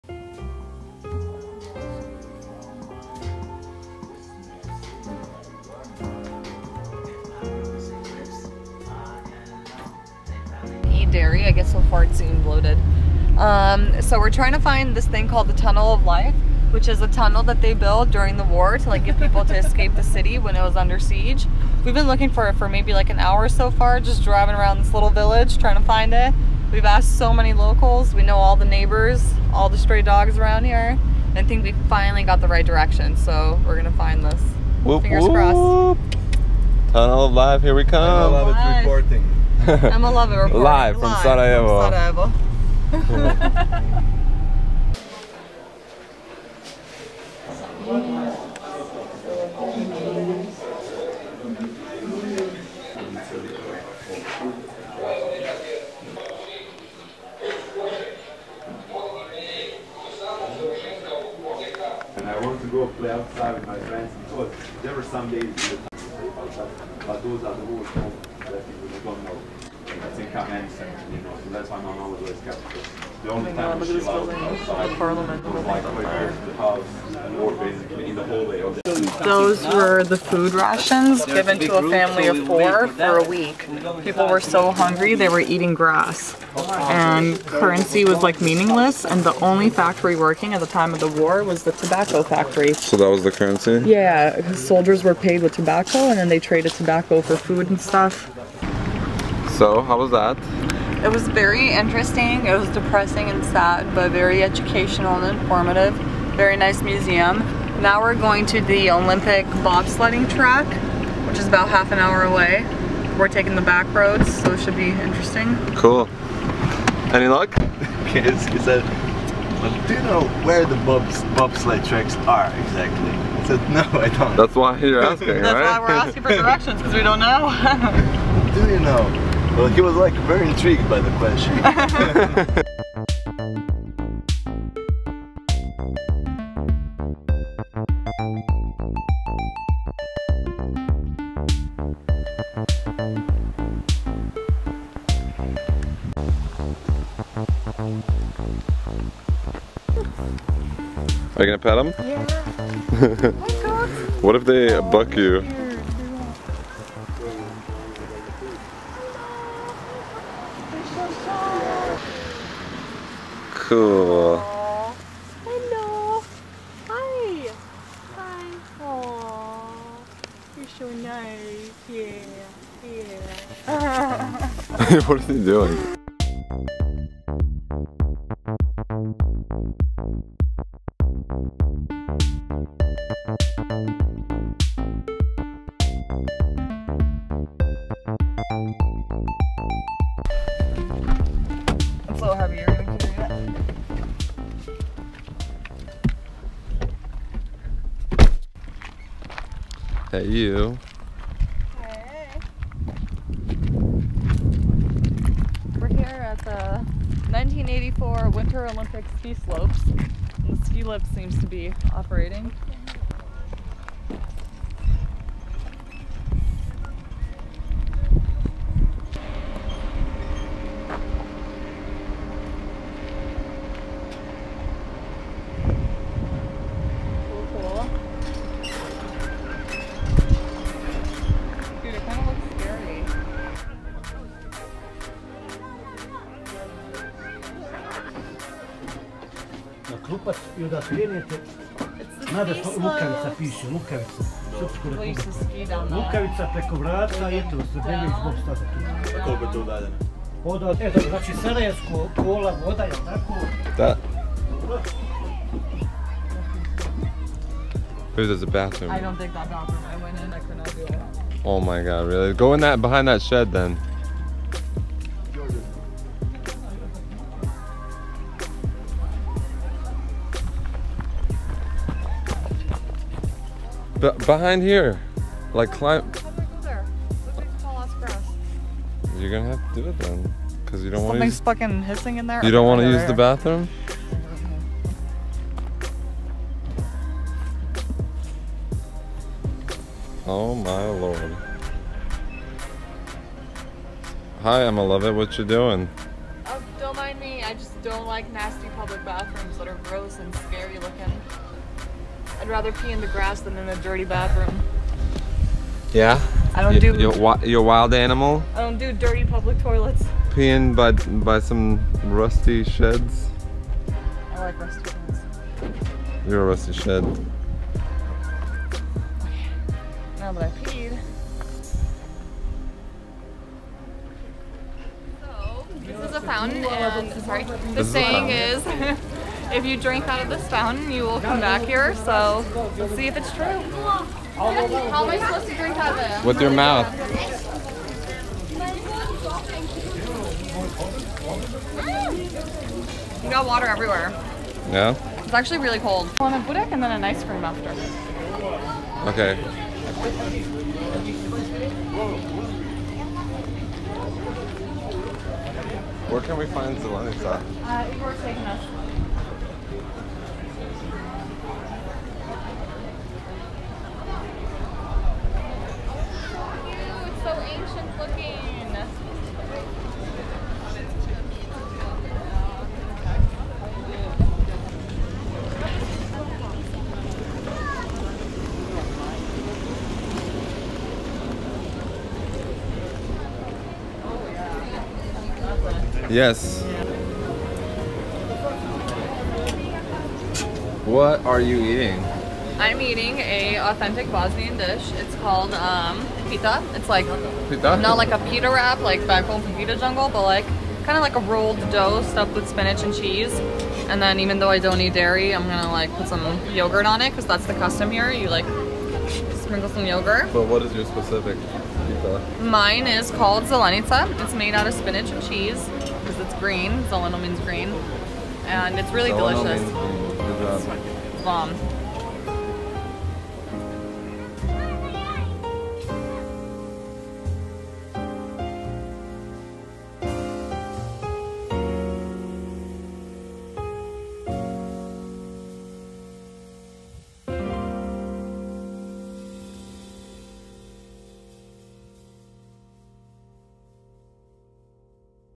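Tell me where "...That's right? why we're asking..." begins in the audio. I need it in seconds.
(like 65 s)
125 s.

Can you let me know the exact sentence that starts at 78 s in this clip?
Or Those were the food rations given to a family of four for a week.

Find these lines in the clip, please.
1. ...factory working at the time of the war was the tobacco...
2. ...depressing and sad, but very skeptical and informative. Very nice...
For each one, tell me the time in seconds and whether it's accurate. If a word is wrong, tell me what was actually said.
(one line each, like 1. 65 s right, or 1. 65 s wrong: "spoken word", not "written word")
1. 89 s right
2. 102 s wrong: "educational", not "skeptical".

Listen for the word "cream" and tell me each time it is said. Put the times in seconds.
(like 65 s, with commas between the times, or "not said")
347 s.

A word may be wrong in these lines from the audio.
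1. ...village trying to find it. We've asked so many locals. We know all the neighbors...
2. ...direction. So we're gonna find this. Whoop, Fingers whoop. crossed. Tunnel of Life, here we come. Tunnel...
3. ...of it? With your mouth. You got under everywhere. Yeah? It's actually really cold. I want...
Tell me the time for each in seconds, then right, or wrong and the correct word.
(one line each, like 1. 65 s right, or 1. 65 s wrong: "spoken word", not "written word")
1. 25 s right
2. 32 s right
3. 335 s wrong: "water", not "under".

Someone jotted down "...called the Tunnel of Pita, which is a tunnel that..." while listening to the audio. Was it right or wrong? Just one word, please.
wrong.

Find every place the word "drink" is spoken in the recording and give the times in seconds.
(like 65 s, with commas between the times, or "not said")
329 s, 335 s.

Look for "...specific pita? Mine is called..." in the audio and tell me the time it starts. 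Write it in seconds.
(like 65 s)
410 s.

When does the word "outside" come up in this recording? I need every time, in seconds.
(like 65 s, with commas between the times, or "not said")
63 s, 74 s.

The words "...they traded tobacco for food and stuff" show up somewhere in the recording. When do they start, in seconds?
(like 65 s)
96 s.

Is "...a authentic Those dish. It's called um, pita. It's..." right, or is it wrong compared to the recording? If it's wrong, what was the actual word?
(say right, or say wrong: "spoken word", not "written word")
wrong: "Bosnian", not "Those".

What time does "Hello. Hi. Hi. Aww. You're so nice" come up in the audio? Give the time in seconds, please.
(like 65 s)
165 s.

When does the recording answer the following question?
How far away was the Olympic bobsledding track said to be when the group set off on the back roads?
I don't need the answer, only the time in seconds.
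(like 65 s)
111 s.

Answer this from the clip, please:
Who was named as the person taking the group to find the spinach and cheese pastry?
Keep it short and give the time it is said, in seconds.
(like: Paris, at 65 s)
Igor, at 357 s.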